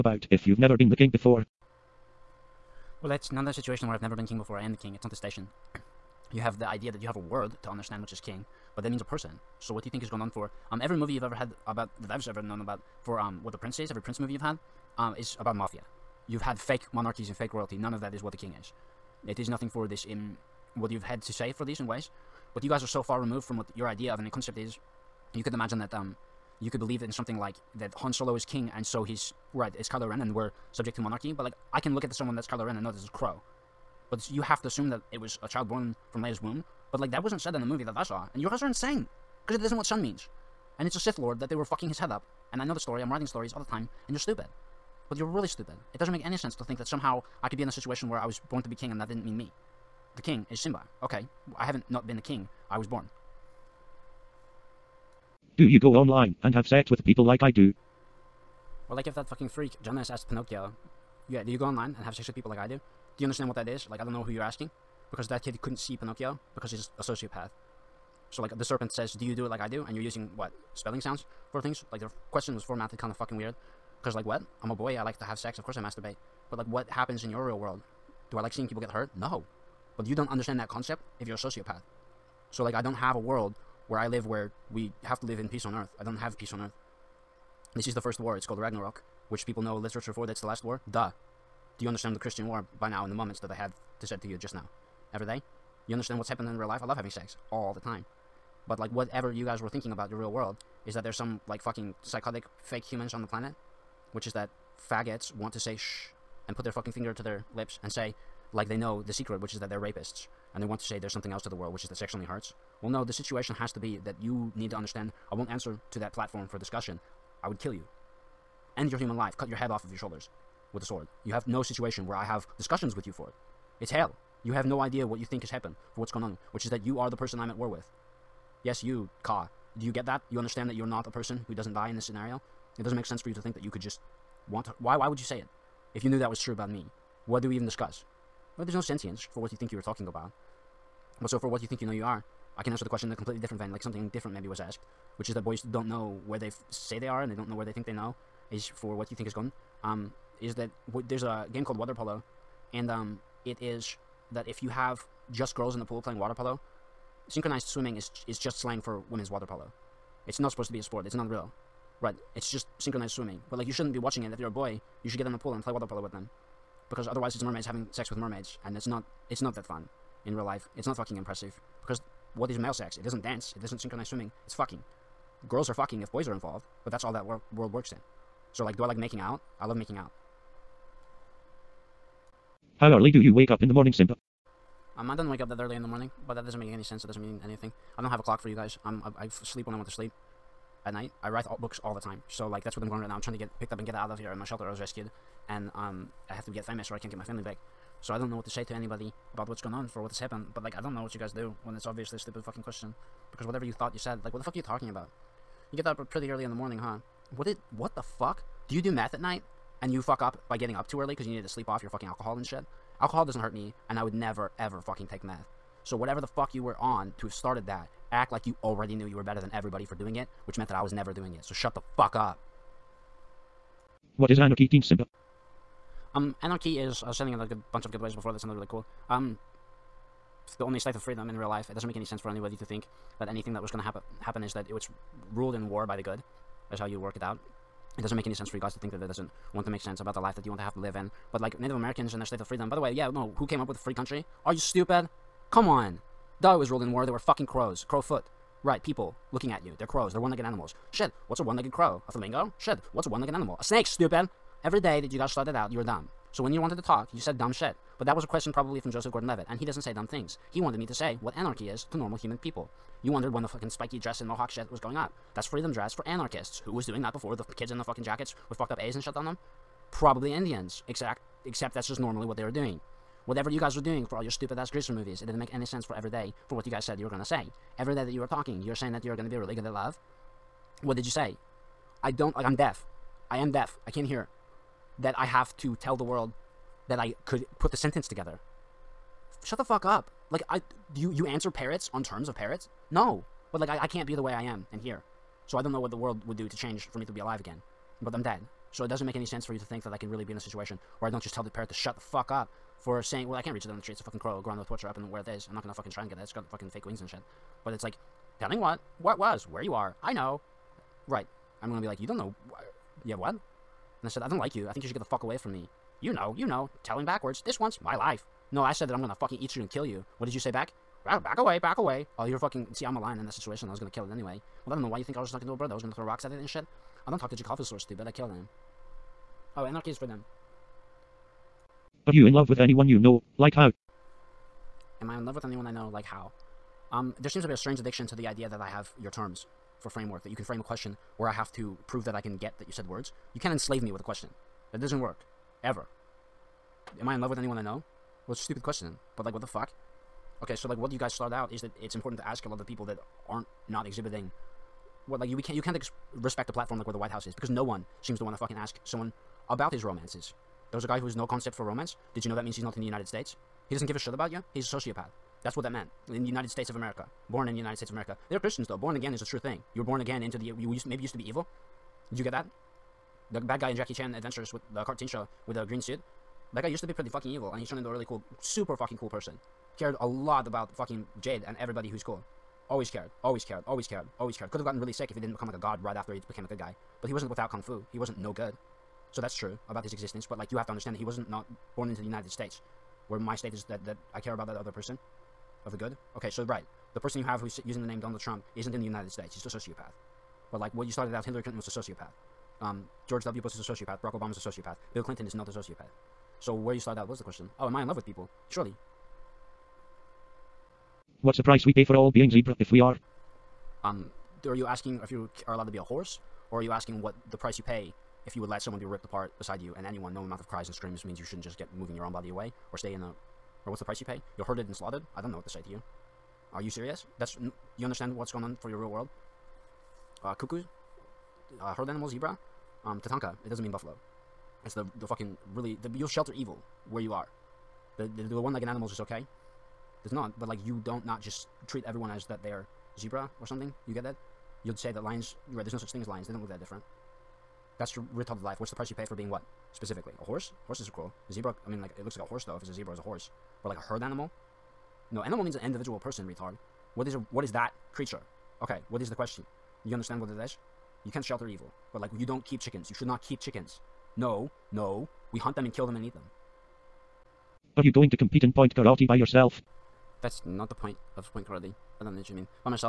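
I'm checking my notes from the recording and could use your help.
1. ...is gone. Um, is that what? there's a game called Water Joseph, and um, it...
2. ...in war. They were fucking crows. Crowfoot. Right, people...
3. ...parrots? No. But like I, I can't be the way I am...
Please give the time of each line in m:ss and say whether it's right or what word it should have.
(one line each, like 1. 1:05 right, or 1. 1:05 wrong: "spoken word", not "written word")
1. 2:29 wrong: "Polo", not "Joseph"
2. 4:06 right
3. 4:52 right.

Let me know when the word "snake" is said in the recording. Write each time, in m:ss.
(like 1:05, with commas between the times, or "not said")
4:13.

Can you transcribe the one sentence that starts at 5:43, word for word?
You can't enslave me with a question.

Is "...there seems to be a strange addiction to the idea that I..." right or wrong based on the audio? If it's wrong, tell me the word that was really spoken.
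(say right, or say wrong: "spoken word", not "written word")
right.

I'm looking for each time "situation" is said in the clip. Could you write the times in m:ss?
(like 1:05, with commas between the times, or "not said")
0:03, 0:47, 1:53, 2:01, 5:00, 5:23.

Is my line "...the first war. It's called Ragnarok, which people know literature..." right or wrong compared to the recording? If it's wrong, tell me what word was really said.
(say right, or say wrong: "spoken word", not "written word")
right.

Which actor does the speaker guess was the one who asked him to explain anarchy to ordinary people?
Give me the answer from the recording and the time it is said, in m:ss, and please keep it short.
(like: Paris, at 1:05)
Joseph Gordon-Levitt, at 4:18.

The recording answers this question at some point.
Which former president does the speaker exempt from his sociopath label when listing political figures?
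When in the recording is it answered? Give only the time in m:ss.
6:44.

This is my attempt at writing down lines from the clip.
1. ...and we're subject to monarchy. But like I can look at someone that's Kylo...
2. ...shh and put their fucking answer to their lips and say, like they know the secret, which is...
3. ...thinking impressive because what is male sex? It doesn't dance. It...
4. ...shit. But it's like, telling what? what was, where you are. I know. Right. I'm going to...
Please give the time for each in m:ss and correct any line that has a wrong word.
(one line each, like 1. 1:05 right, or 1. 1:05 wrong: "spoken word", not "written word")
1. 0:30 right
2. 1:45 wrong: "finger", not "answer"
3. 2:50 wrong: "fucking", not "thinking"
4. 5:07 right.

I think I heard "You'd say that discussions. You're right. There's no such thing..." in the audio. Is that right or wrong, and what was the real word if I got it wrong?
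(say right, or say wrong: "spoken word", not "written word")
wrong: "lions", not "discussions".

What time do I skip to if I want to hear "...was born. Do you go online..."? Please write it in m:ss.
0:52.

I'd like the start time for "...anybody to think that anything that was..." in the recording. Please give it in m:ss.
3:52.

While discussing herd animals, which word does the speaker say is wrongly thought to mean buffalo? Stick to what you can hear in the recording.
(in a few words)
Tatanka.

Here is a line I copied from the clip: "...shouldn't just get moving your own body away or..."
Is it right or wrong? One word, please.
right.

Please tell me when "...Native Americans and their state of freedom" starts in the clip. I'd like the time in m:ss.
4:01.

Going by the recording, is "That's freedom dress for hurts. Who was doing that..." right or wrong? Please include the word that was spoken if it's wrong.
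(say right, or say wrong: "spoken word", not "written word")
wrong: "anarchists", not "hurts".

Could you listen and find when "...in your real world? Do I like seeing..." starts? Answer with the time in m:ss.
1:17.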